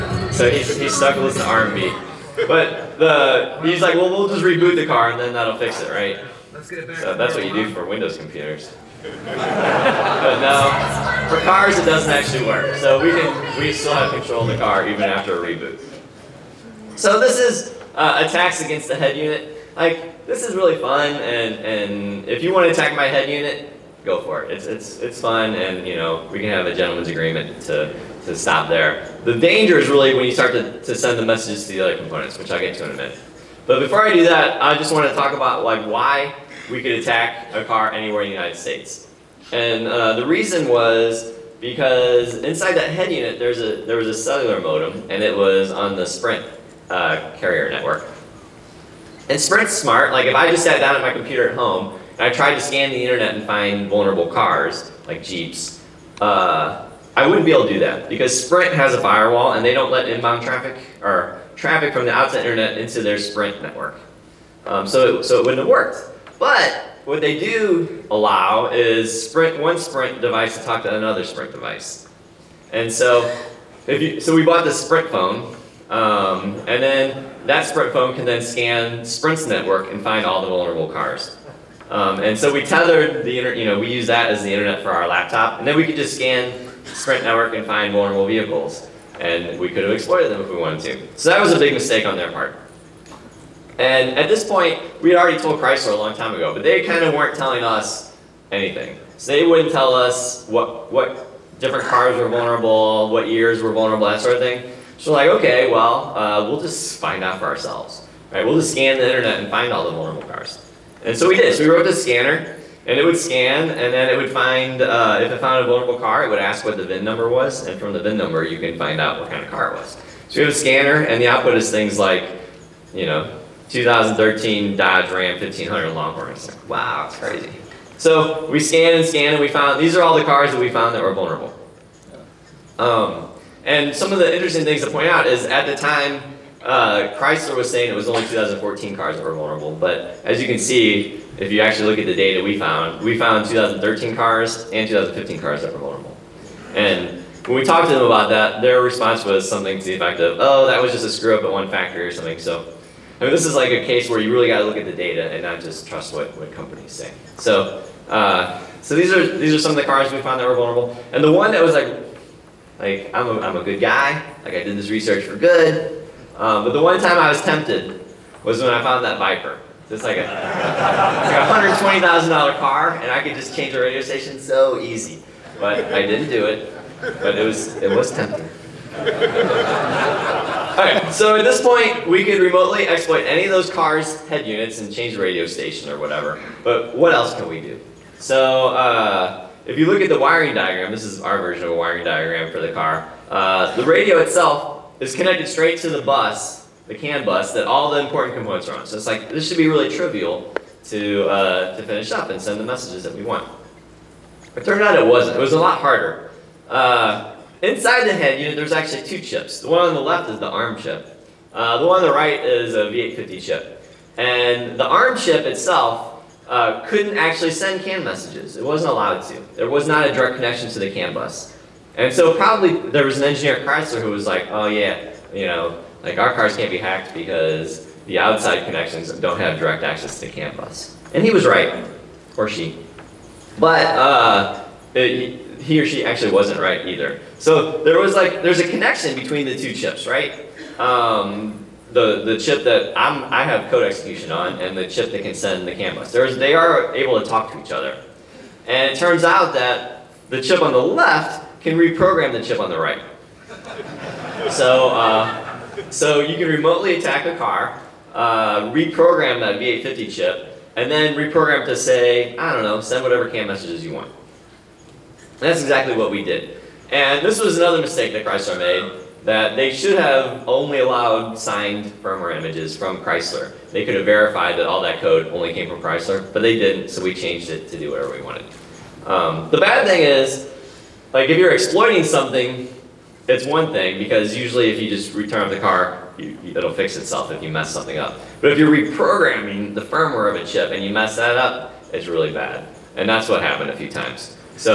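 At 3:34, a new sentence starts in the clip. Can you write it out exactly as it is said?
And the ARM chip itself uh, couldn't actually send CAN messages.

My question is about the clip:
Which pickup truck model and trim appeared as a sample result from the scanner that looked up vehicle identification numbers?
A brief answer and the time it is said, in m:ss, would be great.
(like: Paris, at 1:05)
Dodge Ram 1500 Longhorn, at 2:04.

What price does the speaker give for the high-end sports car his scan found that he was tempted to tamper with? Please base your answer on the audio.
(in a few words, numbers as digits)
$120,000.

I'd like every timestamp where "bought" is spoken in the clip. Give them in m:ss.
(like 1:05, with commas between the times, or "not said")
1:14.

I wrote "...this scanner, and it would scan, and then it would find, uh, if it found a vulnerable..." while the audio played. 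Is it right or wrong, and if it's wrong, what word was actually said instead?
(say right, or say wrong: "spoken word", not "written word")
right.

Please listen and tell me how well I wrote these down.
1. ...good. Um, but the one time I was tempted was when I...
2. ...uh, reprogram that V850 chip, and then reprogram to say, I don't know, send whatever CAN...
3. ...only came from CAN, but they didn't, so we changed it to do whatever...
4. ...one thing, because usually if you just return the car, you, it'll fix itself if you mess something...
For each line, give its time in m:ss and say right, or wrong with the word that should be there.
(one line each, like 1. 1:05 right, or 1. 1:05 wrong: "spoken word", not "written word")
1. 2:45 right
2. 4:18 right
3. 4:35 wrong: "Chrysler", not "CAN"
4. 4:43 right.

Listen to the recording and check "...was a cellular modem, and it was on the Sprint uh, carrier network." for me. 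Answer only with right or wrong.
right.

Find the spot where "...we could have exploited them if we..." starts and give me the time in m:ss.
1:29.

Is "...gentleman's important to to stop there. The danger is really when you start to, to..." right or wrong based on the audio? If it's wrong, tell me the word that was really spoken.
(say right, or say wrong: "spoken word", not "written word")
wrong: "agreement", not "important".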